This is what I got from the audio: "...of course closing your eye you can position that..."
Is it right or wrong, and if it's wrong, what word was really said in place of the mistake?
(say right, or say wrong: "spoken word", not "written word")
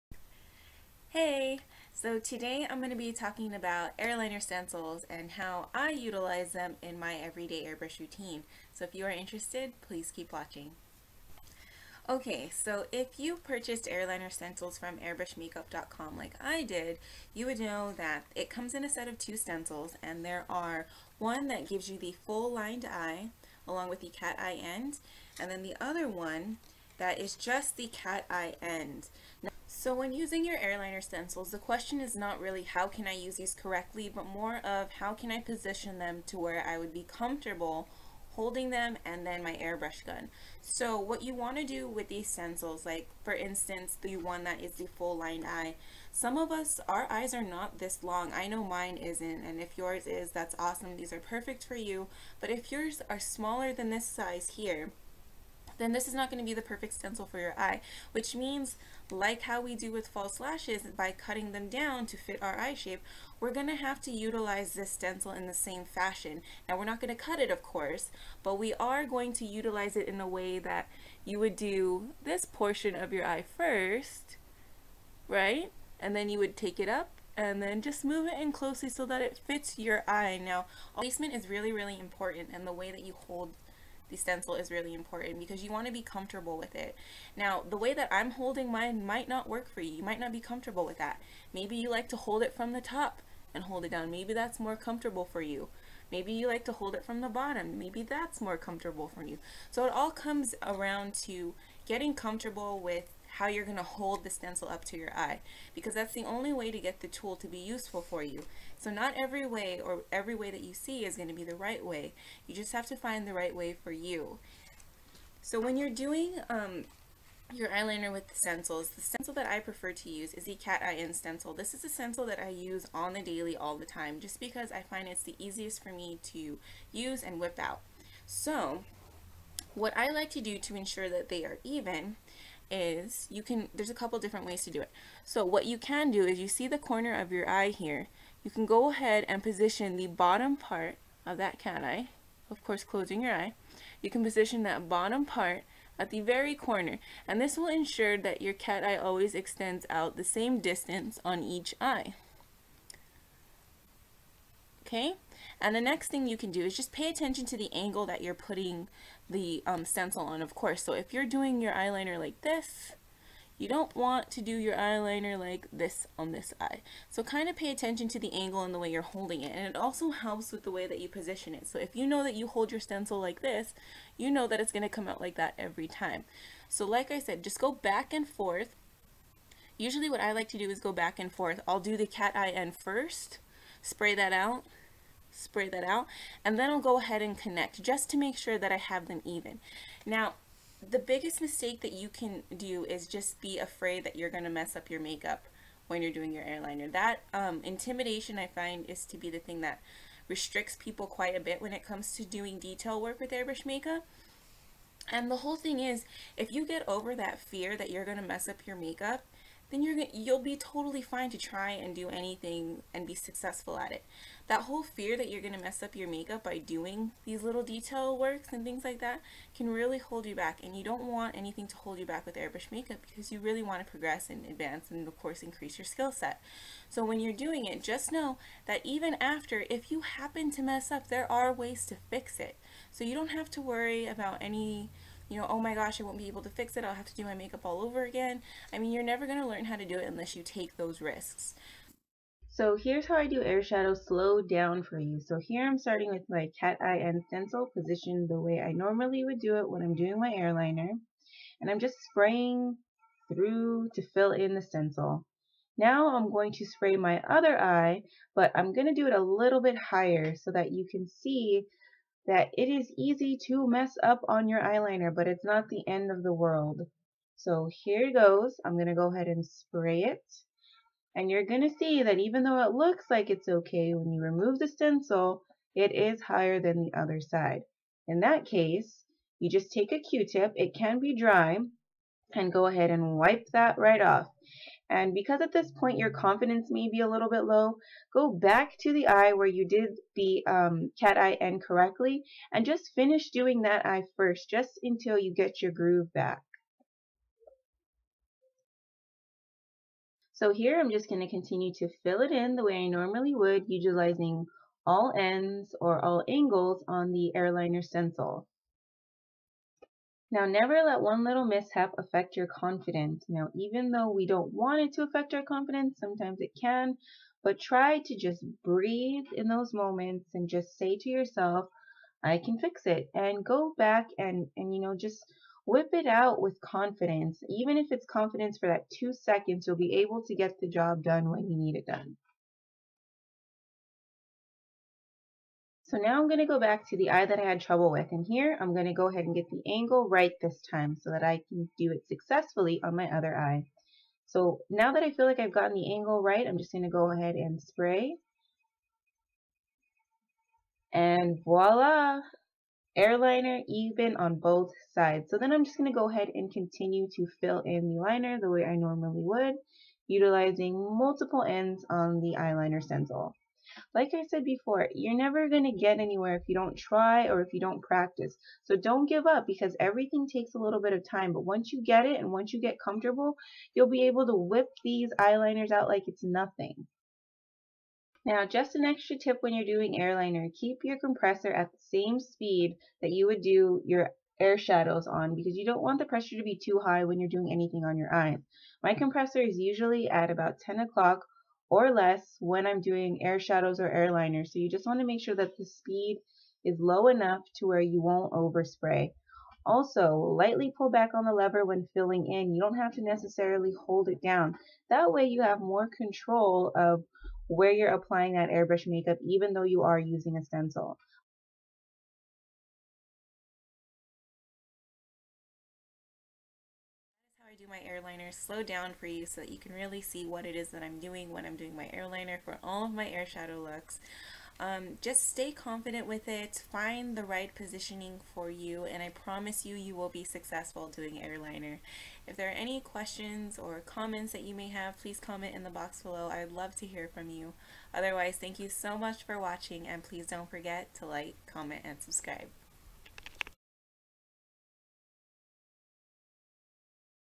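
right.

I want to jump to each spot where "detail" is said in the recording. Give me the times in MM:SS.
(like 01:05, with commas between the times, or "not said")
03:22, 03:37.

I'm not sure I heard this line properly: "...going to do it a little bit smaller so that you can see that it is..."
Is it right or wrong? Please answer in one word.
wrong.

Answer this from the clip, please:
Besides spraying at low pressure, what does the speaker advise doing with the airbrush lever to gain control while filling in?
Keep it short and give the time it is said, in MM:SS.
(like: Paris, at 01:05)
Lightly pull back, at 06:40.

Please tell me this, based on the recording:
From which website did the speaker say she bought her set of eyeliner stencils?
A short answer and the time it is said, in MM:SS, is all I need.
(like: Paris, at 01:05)
airbrushmakeup.com, at 00:14.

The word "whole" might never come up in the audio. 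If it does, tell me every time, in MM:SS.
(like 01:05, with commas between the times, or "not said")
03:25, 03:34.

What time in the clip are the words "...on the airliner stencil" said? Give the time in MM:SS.
05:06.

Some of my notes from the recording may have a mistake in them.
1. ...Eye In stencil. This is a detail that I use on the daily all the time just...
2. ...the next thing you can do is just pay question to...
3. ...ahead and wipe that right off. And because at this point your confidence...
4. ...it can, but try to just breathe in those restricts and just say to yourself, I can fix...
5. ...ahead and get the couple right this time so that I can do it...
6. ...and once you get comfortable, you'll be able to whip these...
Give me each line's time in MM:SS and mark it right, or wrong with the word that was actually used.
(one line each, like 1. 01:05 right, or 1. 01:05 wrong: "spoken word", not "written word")
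1. 02:00 wrong: "stencil", not "detail"
2. 02:35 wrong: "attention", not "question"
3. 04:42 right
4. 05:16 wrong: "moments", not "restricts"
5. 05:39 wrong: "angle", not "couple"
6. 06:12 right.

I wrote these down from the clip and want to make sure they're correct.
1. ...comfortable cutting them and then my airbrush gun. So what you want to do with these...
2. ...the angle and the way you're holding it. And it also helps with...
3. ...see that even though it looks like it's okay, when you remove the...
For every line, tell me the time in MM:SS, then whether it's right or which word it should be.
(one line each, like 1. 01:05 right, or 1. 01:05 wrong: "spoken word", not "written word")
1. 00:37 wrong: "holding", not "cutting"
2. 02:48 right
3. 04:31 right.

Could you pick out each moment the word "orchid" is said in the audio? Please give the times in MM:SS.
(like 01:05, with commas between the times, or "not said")
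not said.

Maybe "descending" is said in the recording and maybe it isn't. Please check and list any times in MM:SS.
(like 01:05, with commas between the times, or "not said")
not said.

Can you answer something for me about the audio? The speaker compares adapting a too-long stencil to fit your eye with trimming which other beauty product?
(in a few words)
False lashes.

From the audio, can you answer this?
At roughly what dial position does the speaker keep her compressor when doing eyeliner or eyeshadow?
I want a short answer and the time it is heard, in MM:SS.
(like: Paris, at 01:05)
10 o'clock, at 06:30.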